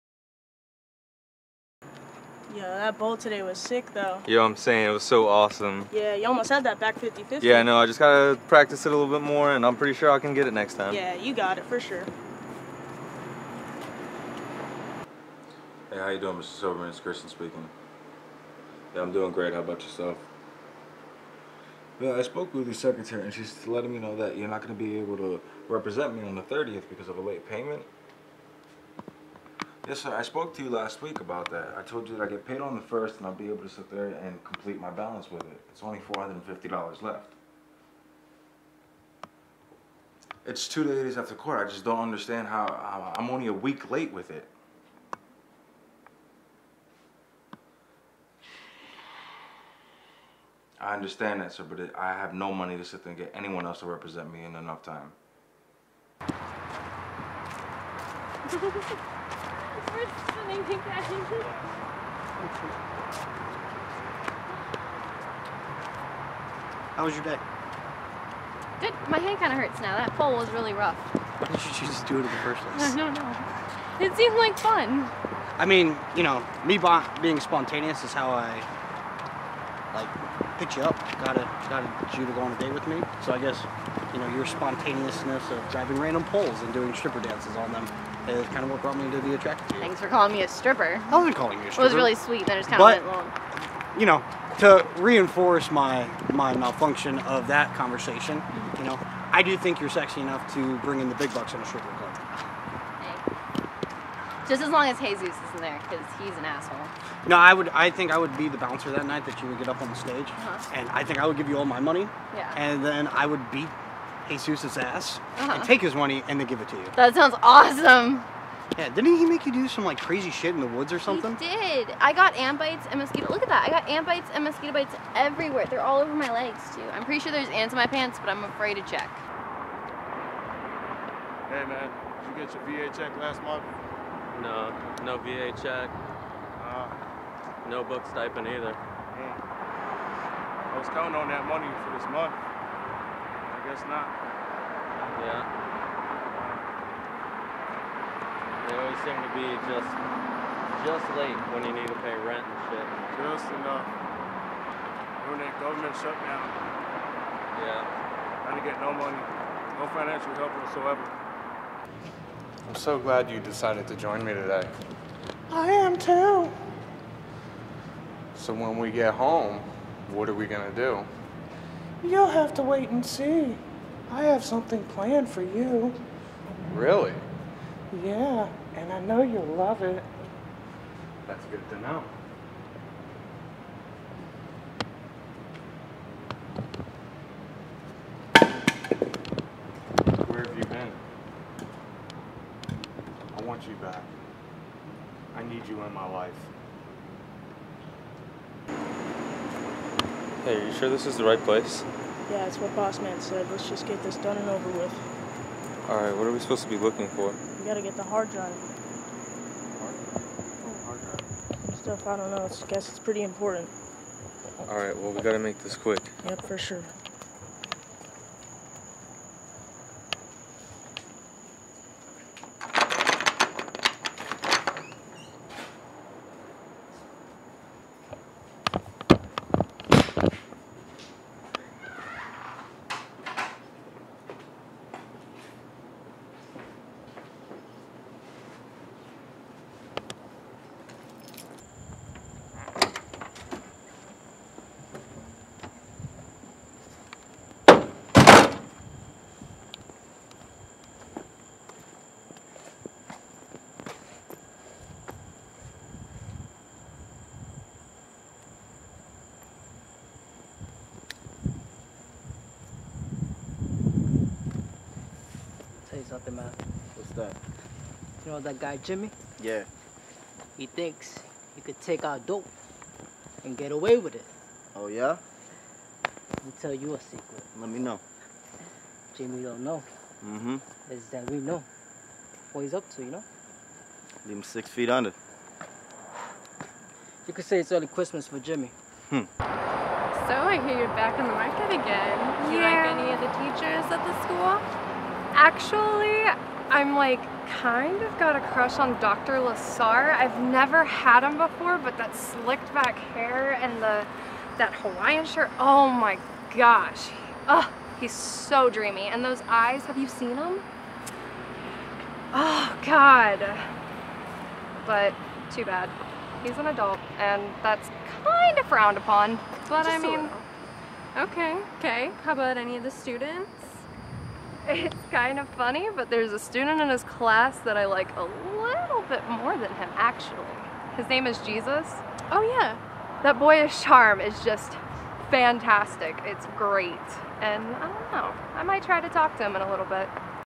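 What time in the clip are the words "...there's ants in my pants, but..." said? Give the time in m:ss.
2:07.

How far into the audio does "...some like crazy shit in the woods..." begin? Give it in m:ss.
1:59.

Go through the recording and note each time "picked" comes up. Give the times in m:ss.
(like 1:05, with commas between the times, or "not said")
1:20.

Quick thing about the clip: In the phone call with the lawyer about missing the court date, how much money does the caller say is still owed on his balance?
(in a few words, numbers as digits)
$450.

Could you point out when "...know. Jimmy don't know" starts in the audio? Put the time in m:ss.
4:37.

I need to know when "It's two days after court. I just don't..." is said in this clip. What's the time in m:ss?
0:40.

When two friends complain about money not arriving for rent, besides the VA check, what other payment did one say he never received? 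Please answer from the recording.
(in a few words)
Book stipend.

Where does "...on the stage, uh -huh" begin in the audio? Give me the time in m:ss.
1:49.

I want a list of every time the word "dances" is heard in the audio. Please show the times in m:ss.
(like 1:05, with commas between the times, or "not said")
1:27.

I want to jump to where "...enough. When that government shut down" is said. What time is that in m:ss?
2:33.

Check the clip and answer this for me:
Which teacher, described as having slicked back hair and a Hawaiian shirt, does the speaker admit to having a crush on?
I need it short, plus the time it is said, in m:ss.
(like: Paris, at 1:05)
Dr. Lasar, at 4:59.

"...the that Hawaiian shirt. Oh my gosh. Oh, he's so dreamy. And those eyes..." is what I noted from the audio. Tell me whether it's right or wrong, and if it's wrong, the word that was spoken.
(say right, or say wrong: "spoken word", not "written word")
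right.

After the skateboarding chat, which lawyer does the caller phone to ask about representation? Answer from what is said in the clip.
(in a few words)
Mr. Silverman.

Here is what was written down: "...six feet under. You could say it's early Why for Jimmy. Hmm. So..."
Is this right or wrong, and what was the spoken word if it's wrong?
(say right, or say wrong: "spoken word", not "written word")
wrong: "Christmas", not "Why".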